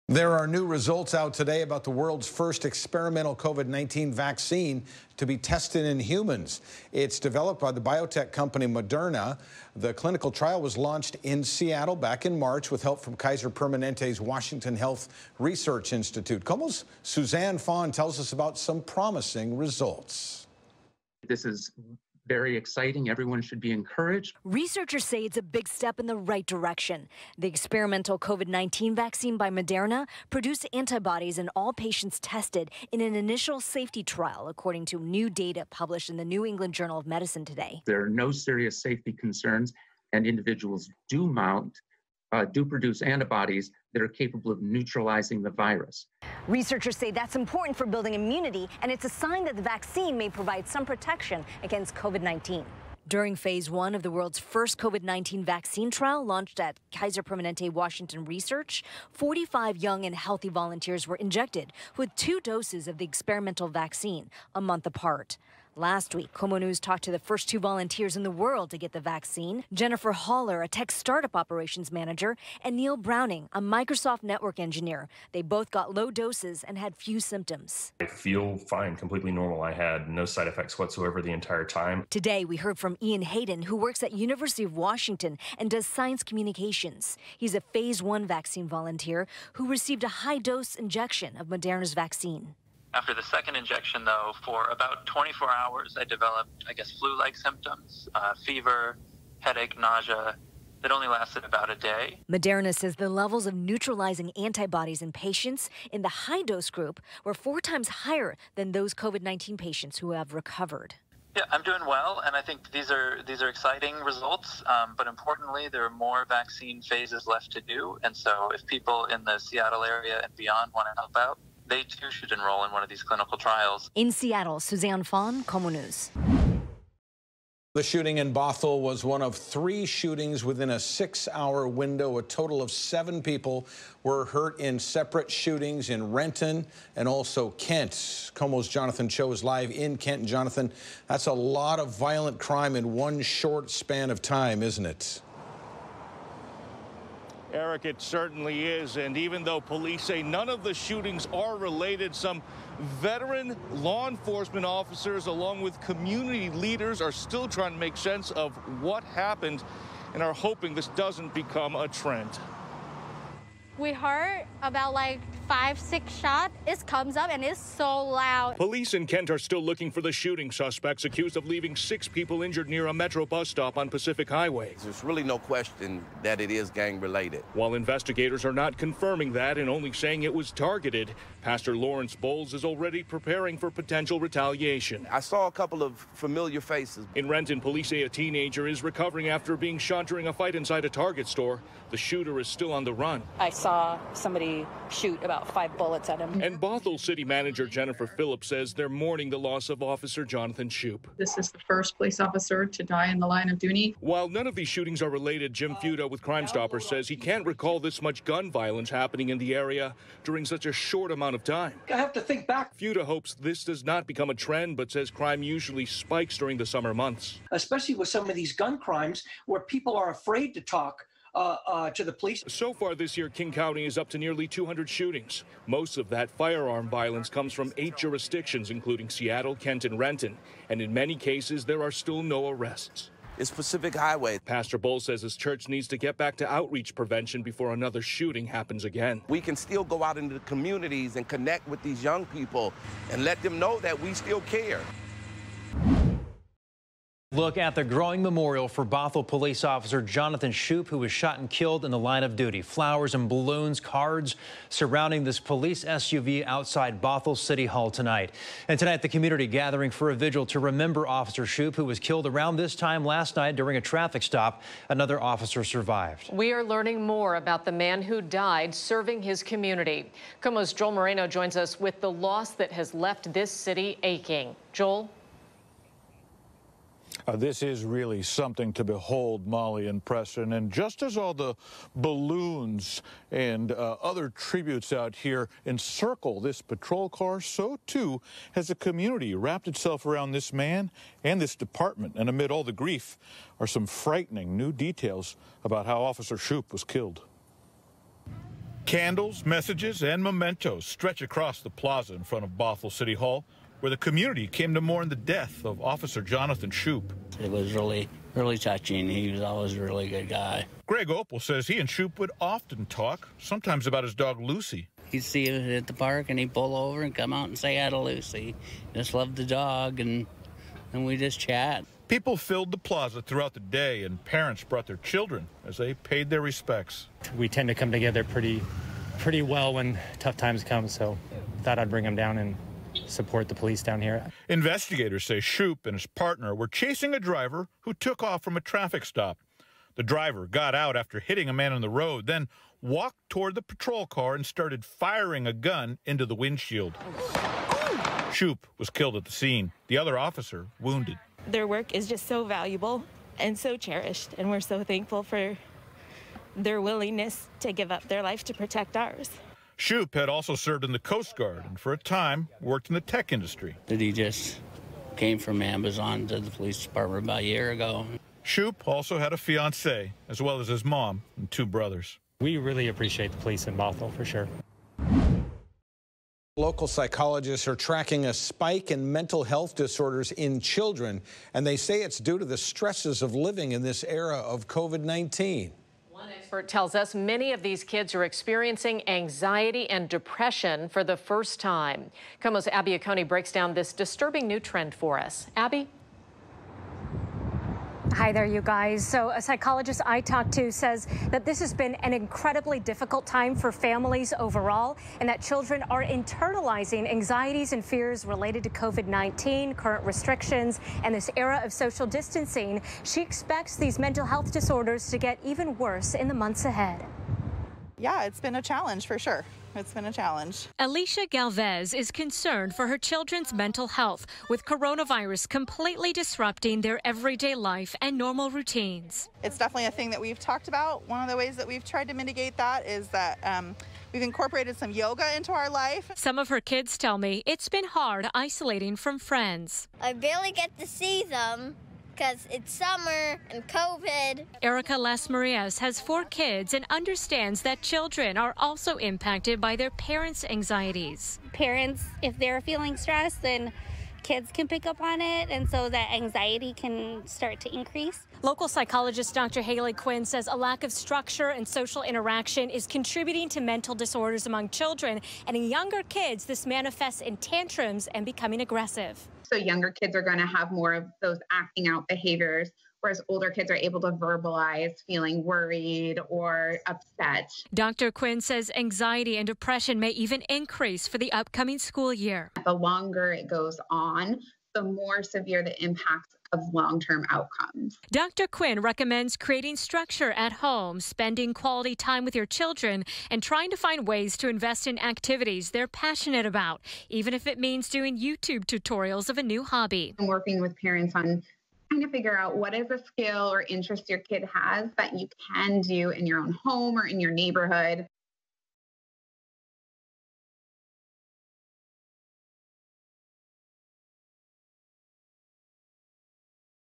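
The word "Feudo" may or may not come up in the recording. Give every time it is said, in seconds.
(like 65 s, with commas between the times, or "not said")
205 s, 212 s.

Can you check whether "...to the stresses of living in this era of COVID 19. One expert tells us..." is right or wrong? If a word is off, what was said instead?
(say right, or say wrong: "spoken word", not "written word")
right.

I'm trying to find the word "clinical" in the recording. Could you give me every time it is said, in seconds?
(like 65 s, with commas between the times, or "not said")
9 s, 123 s.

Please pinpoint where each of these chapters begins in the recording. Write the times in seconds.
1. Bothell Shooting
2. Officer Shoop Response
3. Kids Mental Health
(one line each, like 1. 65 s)
1. 126 s
2. 246 s
3. 376 s.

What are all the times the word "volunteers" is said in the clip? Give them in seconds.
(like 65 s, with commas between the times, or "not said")
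60 s, 67 s, 88 s.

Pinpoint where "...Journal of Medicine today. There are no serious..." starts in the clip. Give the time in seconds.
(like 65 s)
36 s.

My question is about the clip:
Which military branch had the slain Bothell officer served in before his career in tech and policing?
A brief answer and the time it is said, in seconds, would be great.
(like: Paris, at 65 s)
Coast Guard, at 360 s.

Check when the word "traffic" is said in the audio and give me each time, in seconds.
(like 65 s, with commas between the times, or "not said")
263 s, 338 s.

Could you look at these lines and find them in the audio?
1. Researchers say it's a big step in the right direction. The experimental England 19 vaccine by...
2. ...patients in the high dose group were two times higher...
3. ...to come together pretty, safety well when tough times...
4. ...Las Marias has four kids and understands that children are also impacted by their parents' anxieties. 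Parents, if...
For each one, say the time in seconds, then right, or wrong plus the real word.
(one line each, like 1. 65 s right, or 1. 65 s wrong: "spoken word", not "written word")
1. 24 s wrong: "COVID", not "England"
2. 105 s wrong: "four", not "two"
3. 327 s wrong: "pretty", not "safety"
4. 444 s right.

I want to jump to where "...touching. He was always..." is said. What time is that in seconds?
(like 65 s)
308 s.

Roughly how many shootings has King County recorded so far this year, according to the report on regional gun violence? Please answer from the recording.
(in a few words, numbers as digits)
nearly 200.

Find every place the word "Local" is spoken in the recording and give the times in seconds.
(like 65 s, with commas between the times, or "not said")
376 s, 458 s.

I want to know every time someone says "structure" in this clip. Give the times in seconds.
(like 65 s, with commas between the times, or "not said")
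460 s, 489 s.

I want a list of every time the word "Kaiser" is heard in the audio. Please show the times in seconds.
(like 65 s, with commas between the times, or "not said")
13 s, 56 s.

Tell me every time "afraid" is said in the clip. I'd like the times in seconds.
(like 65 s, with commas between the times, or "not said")
220 s.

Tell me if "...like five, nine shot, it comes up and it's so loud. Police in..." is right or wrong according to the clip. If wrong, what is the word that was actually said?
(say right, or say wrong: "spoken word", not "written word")
wrong: "six", not "nine".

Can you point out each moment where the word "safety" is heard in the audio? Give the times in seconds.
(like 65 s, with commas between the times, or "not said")
33 s, 38 s.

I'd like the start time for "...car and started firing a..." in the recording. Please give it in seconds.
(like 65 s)
344 s.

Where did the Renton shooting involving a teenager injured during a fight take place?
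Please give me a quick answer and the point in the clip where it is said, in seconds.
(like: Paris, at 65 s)
Target store, at 190 s.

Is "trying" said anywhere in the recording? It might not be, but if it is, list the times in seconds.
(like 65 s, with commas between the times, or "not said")
157 s, 493 s, 501 s.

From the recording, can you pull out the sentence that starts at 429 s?
It's definitely a thing that we've talked about.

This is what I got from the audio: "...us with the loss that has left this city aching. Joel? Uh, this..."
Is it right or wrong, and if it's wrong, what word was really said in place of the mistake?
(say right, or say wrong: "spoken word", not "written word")
right.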